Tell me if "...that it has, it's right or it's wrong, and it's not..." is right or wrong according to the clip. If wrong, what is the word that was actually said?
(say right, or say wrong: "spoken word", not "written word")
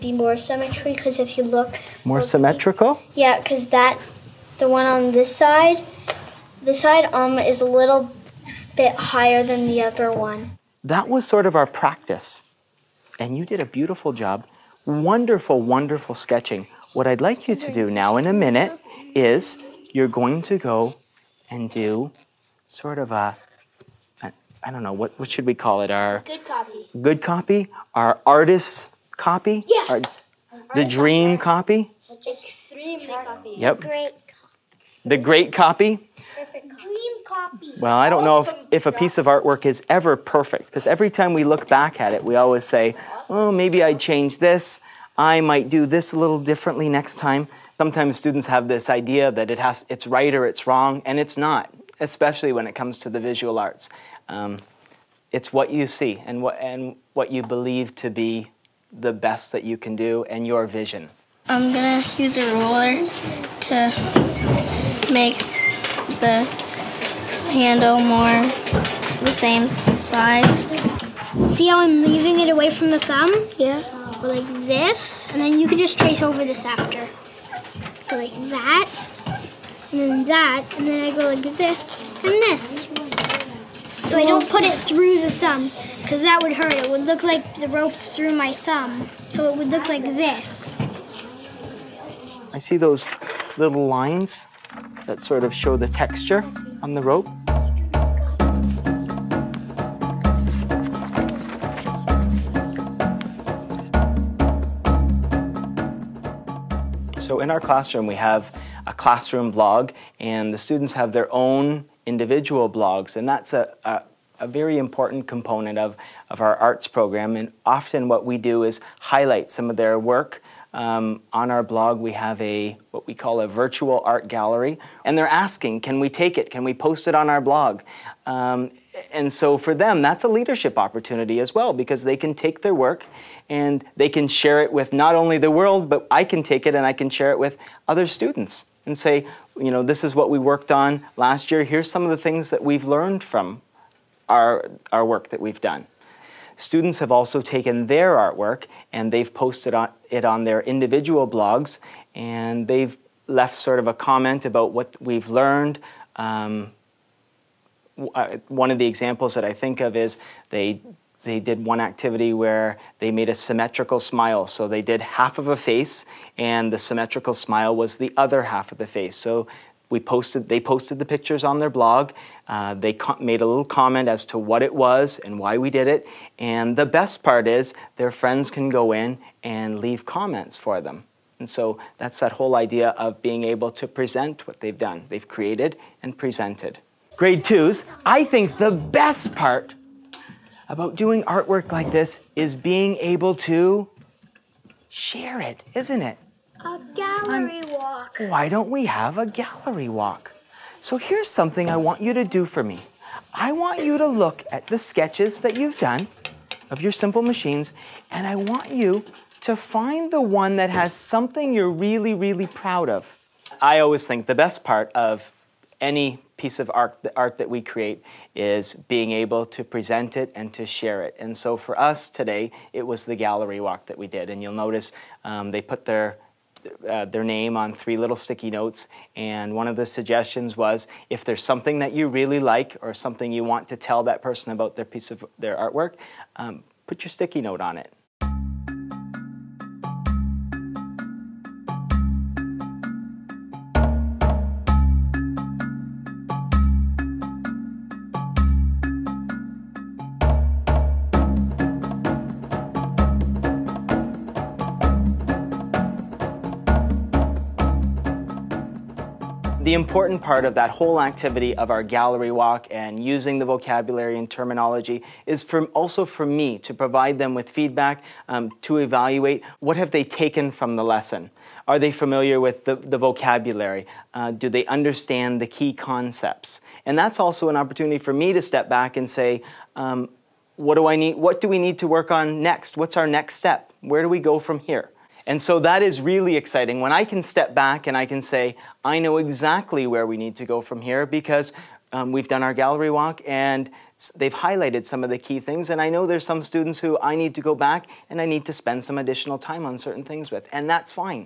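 right.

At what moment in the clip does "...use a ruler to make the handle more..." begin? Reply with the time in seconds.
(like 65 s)
62 s.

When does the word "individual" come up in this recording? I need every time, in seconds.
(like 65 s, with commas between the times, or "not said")
112 s, 150 s.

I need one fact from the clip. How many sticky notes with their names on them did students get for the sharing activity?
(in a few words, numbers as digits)
3.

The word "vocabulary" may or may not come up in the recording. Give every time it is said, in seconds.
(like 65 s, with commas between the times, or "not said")
263 s, 272 s.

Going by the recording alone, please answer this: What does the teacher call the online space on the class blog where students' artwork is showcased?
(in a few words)
virtual art gallery.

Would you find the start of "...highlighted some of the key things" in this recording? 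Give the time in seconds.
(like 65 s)
294 s.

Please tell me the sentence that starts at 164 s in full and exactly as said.
So they did half of a face, and the symmetrical smile was the other half of the face.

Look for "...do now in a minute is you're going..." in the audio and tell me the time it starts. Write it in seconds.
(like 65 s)
17 s.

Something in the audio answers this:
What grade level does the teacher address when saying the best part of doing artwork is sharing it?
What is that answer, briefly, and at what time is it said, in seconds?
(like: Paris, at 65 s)
grade 2, at 187 s.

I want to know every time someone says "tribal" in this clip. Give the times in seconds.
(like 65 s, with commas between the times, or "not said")
not said.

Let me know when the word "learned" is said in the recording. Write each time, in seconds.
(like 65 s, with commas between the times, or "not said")
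142 s, 155 s.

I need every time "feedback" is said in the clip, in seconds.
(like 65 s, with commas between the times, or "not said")
267 s.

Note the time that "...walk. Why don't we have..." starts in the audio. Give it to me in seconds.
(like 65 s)
197 s.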